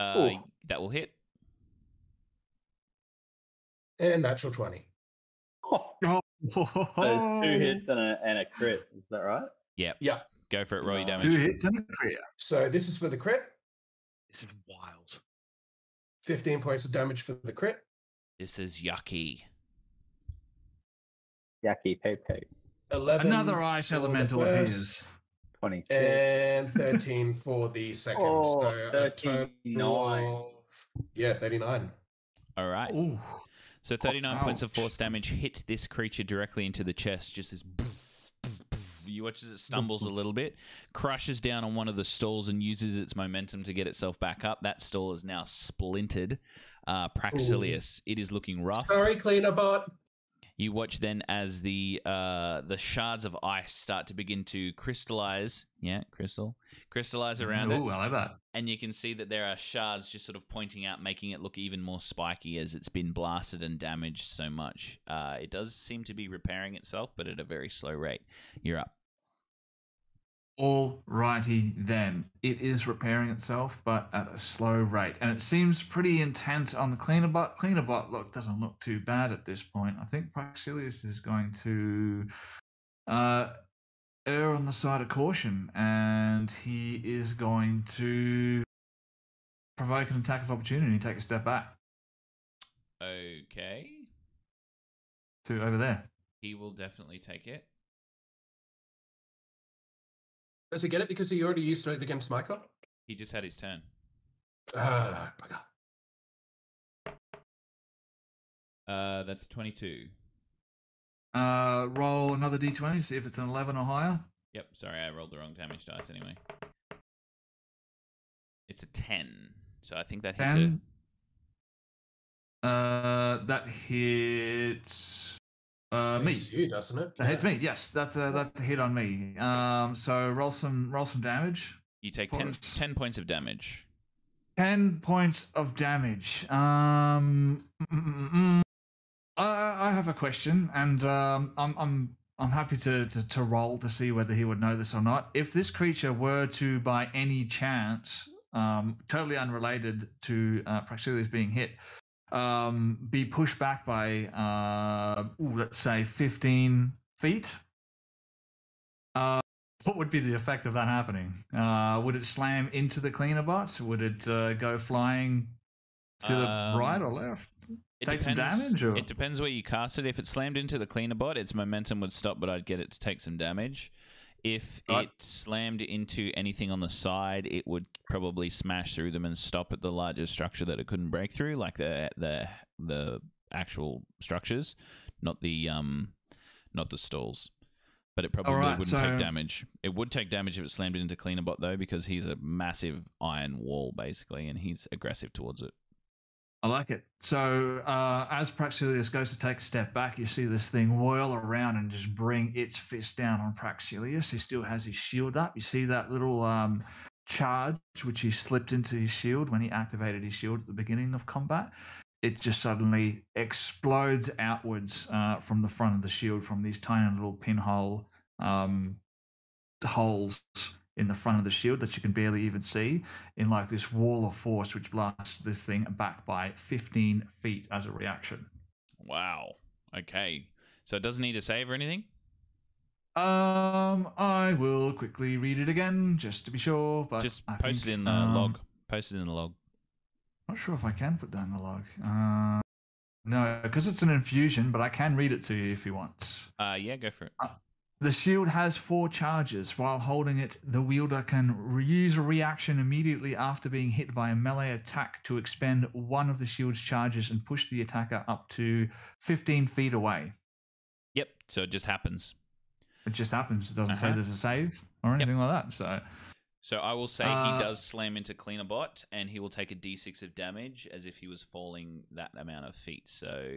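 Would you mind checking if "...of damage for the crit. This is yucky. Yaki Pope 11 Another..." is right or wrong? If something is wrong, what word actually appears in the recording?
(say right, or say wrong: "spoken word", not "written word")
right.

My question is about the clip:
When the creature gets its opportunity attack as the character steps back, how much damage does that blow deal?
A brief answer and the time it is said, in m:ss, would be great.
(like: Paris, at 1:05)
10, at 2:12.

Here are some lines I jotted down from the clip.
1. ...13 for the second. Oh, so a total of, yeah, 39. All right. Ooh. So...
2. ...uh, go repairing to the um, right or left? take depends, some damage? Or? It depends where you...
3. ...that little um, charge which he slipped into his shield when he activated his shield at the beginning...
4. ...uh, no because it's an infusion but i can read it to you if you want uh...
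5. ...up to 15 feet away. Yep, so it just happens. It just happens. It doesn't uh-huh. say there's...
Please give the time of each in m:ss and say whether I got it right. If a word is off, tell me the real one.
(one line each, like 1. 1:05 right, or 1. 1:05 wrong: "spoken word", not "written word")
1. 0:26 right
2. 2:44 wrong: "flying", not "repairing"
3. 3:25 right
4. 4:02 right
5. 4:18 right.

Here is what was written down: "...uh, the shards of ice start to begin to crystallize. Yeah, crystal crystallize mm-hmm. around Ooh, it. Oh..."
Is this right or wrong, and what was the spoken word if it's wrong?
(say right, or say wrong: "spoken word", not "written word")
right.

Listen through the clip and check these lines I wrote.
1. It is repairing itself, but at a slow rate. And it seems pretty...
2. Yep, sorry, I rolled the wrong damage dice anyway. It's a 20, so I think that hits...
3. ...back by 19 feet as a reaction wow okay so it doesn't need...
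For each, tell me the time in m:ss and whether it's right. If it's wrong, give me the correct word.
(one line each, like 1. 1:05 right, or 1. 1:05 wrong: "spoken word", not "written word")
1. 1:12 right
2. 1:54 wrong: "10", not "20"
3. 3:45 wrong: "15", not "19".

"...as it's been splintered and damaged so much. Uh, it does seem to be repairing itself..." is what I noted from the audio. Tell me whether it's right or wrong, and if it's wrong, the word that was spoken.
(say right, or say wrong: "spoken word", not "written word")
wrong: "blasted", not "splintered".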